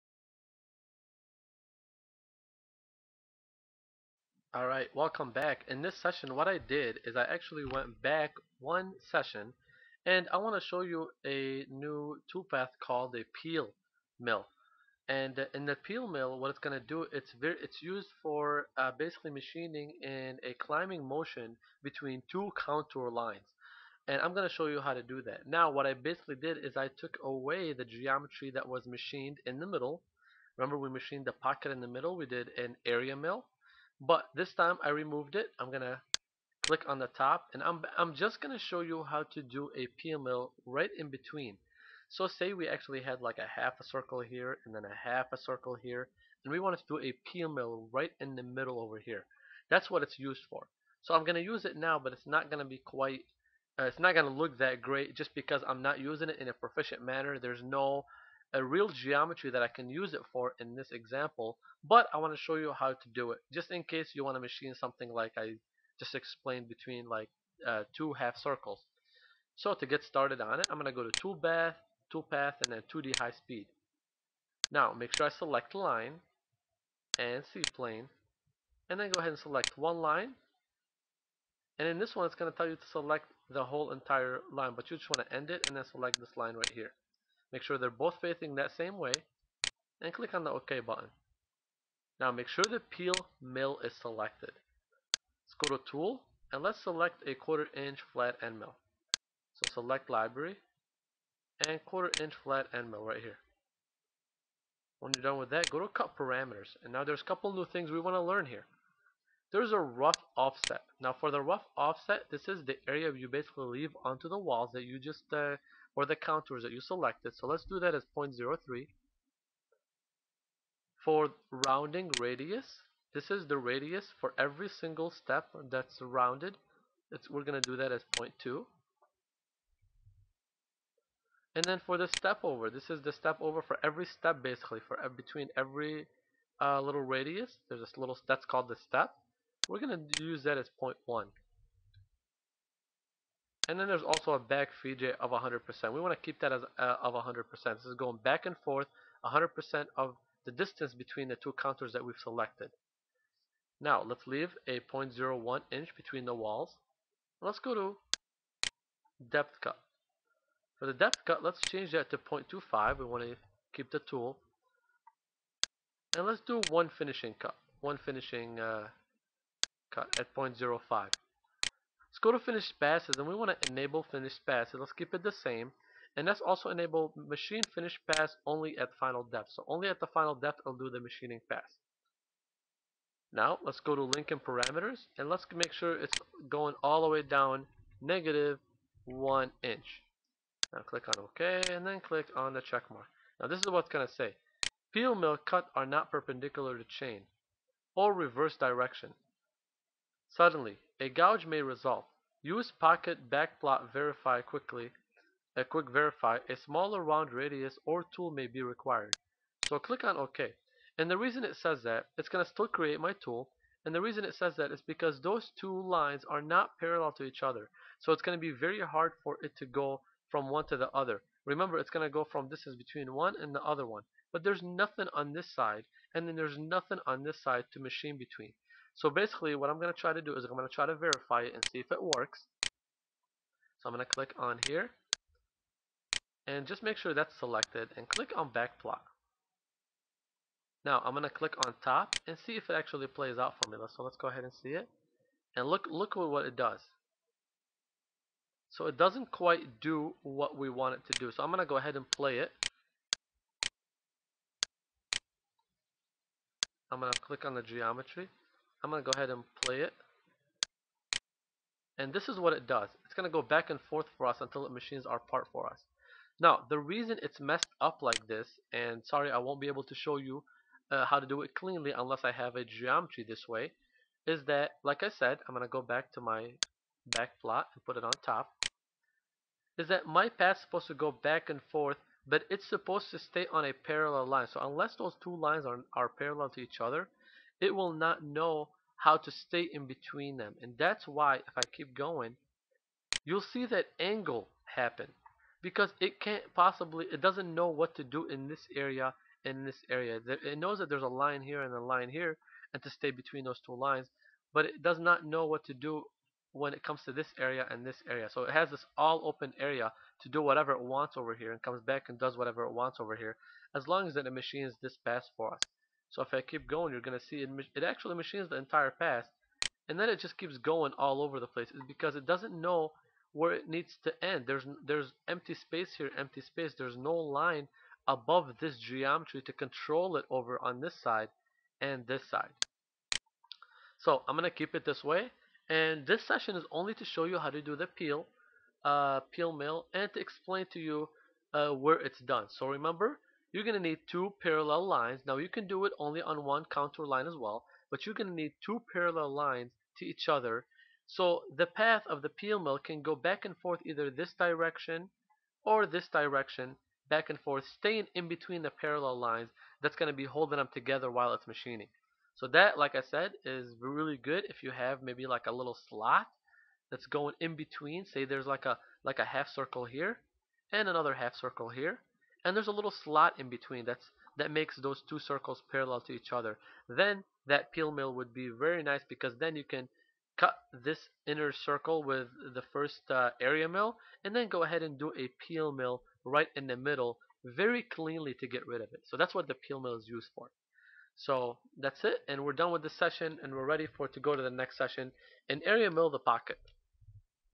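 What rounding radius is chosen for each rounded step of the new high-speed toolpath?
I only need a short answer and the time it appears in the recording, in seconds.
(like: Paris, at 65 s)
0.2, at 128 s.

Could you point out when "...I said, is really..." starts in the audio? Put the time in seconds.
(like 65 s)
362 s.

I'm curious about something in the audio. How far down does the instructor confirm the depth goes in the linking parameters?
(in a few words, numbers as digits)
negative one inch.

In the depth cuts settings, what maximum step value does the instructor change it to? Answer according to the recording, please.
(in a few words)
0.25.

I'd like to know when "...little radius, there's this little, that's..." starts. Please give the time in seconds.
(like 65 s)
136 s.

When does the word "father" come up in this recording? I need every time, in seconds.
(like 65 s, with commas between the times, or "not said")
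not said.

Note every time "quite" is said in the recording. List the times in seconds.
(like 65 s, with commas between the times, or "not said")
52 s, 249 s.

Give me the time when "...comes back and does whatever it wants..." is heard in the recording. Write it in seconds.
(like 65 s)
311 s.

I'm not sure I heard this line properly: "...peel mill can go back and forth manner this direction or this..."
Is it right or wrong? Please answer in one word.
wrong.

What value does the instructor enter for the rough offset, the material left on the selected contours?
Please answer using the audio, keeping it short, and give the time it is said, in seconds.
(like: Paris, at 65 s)
0.03, at 118 s.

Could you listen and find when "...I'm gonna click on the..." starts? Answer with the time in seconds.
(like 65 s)
35 s.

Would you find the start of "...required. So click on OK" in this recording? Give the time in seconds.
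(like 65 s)
208 s.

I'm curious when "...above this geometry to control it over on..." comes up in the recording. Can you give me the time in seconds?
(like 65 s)
328 s.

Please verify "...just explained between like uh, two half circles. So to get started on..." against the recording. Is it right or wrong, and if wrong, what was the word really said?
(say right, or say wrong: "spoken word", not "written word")
right.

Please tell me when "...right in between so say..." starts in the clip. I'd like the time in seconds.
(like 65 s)
40 s.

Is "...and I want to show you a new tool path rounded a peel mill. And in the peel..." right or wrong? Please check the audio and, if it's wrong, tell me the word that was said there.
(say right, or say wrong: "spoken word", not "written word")
wrong: "called", not "rounded".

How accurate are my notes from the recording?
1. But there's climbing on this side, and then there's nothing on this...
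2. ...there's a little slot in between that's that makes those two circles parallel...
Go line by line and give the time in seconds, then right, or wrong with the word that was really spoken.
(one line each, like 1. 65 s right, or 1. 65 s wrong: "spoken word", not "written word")
1. 224 s wrong: "nothing", not "climbing"
2. 372 s right.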